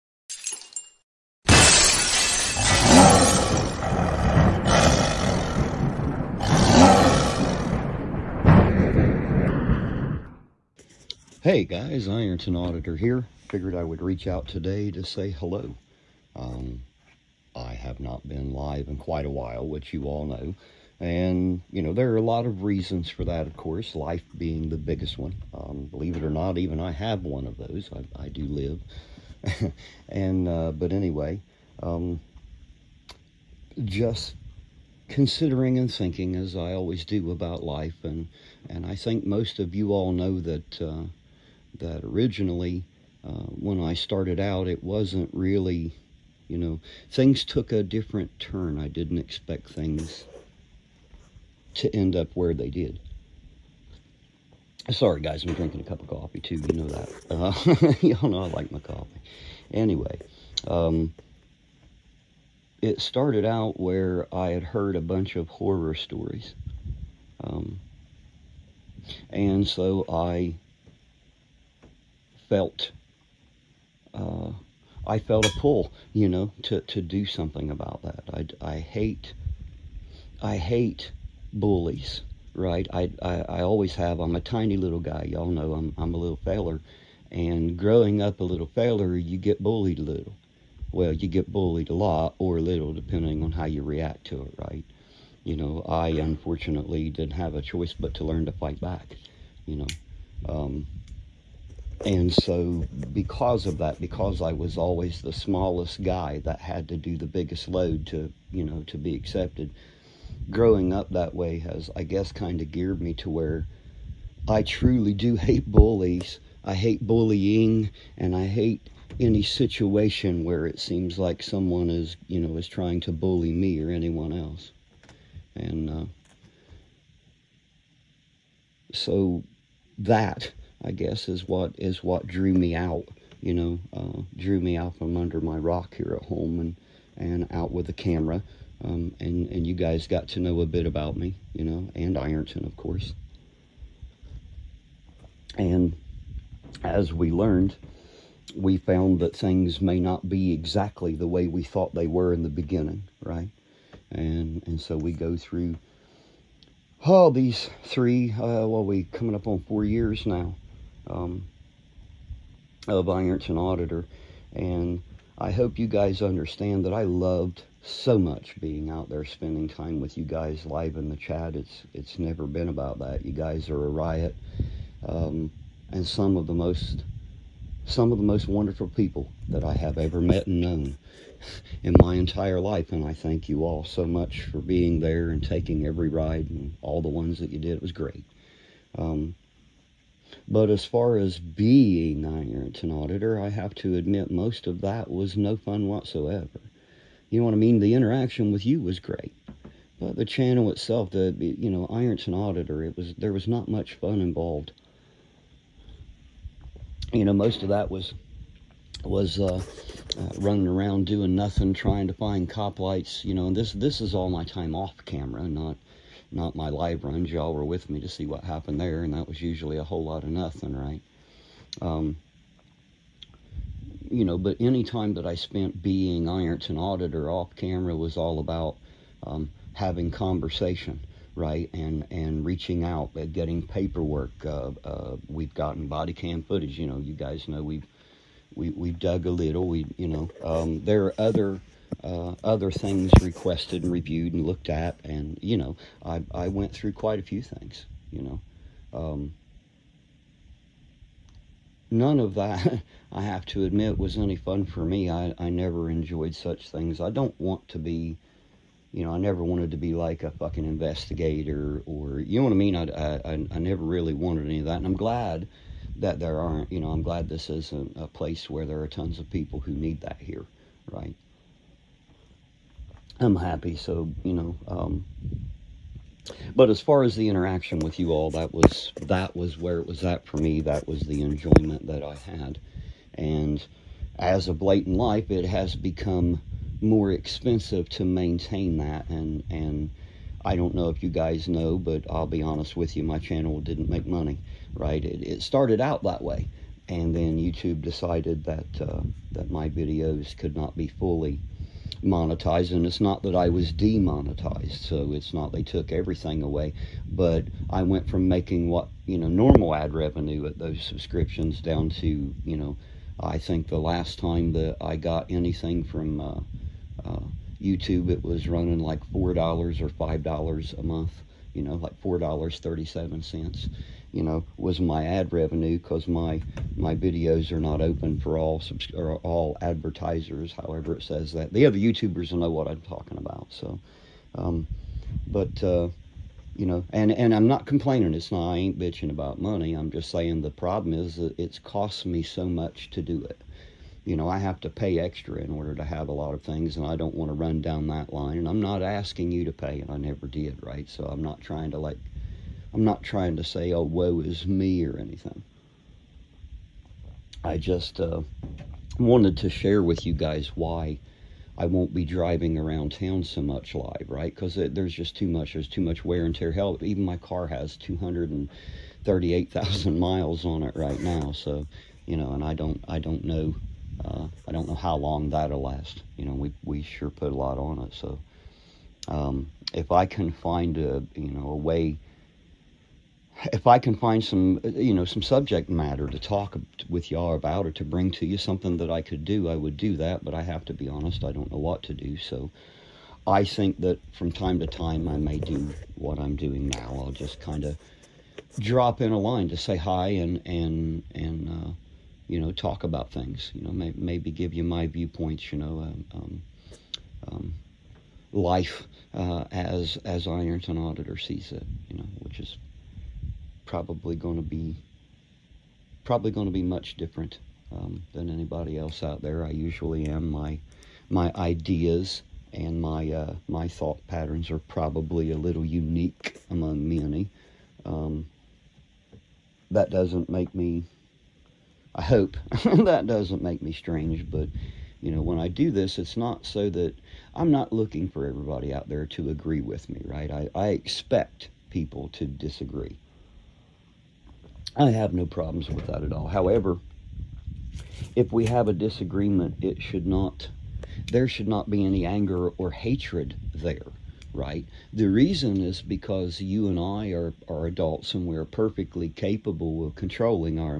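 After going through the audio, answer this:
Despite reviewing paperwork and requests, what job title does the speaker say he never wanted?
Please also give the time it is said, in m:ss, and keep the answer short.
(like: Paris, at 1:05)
investigator, at 4:20.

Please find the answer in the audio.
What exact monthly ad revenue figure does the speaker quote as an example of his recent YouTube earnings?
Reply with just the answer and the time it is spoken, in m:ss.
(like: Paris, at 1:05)
$4.37, at 5:22.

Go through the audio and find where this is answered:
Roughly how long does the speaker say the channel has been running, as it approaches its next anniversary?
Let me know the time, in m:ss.
2:39.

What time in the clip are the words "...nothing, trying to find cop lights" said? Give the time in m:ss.
3:31.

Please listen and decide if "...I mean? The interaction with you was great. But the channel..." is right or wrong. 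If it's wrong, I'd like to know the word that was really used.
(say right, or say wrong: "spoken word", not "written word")
right.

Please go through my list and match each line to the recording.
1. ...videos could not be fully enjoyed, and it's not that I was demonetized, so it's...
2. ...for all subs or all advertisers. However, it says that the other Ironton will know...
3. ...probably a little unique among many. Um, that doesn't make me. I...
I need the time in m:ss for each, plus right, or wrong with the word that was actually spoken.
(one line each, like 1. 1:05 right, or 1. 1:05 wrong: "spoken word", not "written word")
1. 4:59 wrong: "monetized", not "enjoyed"
2. 5:28 wrong: "YouTubers", not "Ironton"
3. 7:04 right.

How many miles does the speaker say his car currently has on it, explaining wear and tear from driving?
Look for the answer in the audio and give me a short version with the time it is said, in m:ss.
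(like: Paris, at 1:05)
238,000, at 6:07.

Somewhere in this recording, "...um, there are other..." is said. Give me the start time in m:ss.
4:00.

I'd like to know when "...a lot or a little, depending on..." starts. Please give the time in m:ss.
1:31.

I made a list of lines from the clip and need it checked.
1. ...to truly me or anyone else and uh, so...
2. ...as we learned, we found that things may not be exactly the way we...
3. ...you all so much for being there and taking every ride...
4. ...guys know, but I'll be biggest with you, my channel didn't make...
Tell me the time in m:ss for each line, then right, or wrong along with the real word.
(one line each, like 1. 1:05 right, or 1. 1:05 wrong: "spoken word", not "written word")
1. 2:02 wrong: "bully", not "truly"
2. 2:26 right
3. 3:03 right
4. 4:51 wrong: "honest", not "biggest".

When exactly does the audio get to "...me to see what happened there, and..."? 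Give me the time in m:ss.
3:37.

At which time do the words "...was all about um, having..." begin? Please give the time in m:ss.
3:47.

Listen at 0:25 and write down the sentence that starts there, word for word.
Um, believe it or not, even I have one of those.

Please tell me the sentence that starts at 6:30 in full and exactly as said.
But I have to be honest, I don't know what to do.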